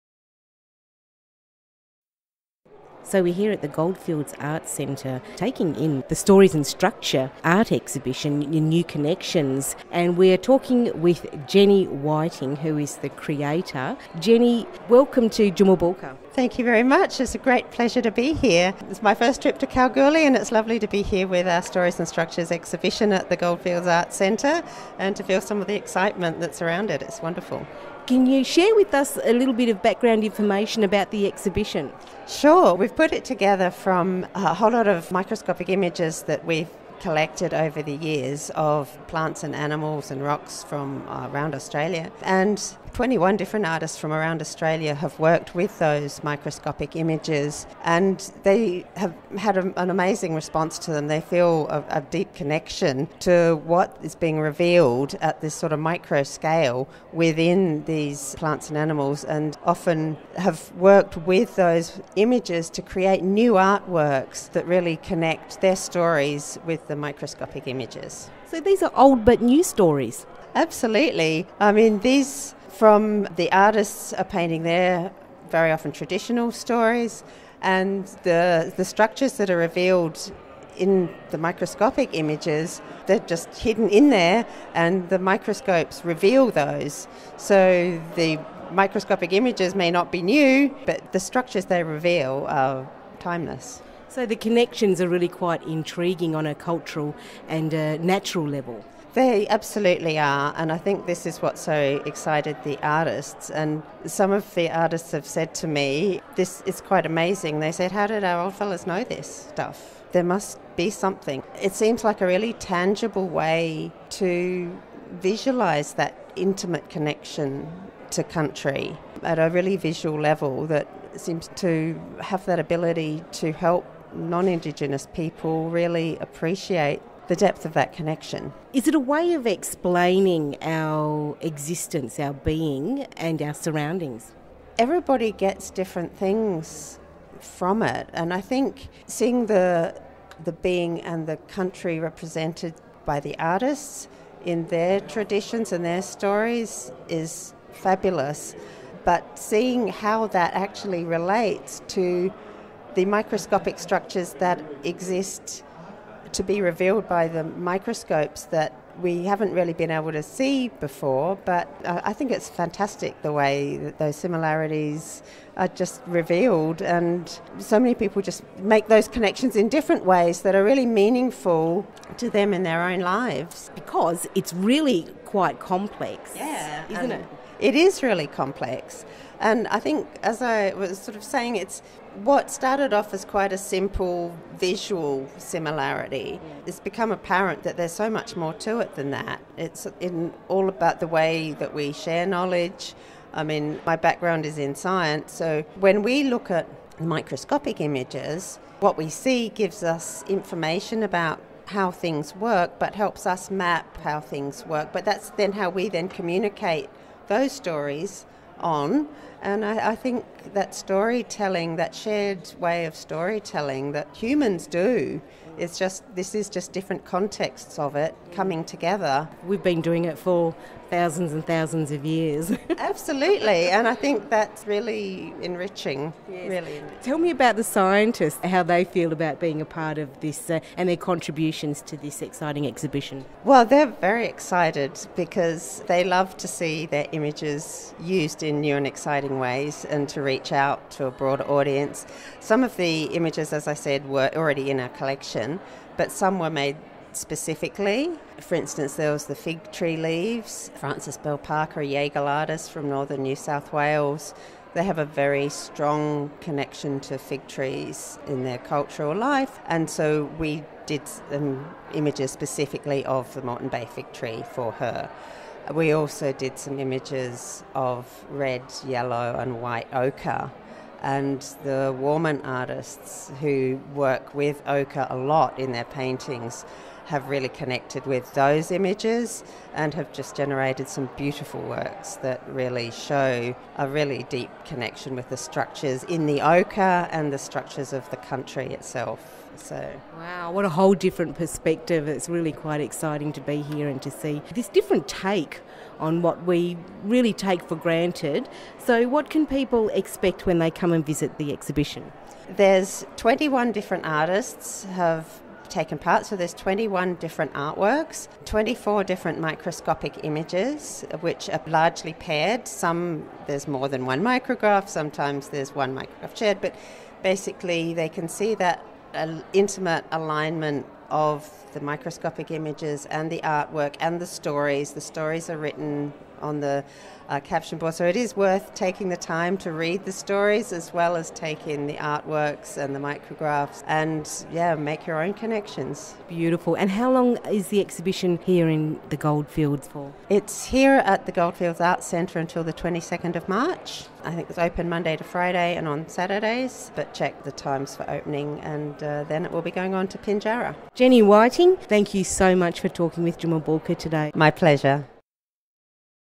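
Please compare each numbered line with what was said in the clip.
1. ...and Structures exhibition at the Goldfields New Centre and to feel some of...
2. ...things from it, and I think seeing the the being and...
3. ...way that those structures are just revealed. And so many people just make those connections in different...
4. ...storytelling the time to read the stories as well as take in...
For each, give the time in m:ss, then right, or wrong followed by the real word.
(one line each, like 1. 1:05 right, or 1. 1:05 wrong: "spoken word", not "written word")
1. 0:21 wrong: "Arts", not "New"
2. 2:16 right
3. 2:43 wrong: "similarities", not "structures"
4. 5:28 wrong: "taking", not "storytelling".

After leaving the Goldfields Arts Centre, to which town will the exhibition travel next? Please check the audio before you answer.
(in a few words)
Pinjarra.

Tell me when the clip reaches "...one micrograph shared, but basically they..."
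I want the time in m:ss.
5:15.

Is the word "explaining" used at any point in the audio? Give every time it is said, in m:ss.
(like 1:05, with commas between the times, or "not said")
2:09.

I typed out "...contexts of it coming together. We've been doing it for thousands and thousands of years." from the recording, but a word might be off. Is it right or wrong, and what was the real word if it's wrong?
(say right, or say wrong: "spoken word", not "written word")
right.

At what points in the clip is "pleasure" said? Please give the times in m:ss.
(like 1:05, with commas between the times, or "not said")
0:17, 5:54.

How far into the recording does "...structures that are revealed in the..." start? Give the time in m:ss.
1:18.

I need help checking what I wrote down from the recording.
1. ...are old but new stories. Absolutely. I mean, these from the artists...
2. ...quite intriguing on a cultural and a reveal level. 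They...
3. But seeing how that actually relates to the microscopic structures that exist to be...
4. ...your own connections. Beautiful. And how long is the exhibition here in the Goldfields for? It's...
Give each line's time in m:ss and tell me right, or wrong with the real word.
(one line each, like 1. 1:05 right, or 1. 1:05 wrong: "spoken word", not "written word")
1. 1:08 right
2. 1:35 wrong: "natural", not "reveal"
3. 2:29 right
4. 5:35 right.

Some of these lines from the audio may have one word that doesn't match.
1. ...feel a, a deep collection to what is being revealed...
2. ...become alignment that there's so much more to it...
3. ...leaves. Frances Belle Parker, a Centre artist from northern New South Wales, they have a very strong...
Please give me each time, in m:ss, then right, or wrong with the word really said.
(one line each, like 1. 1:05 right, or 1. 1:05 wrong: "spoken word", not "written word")
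1. 0:51 wrong: "connection", not "collection"
2. 3:06 wrong: "apparent", not "alignment"
3. 4:09 wrong: "Yaegl", not "Centre".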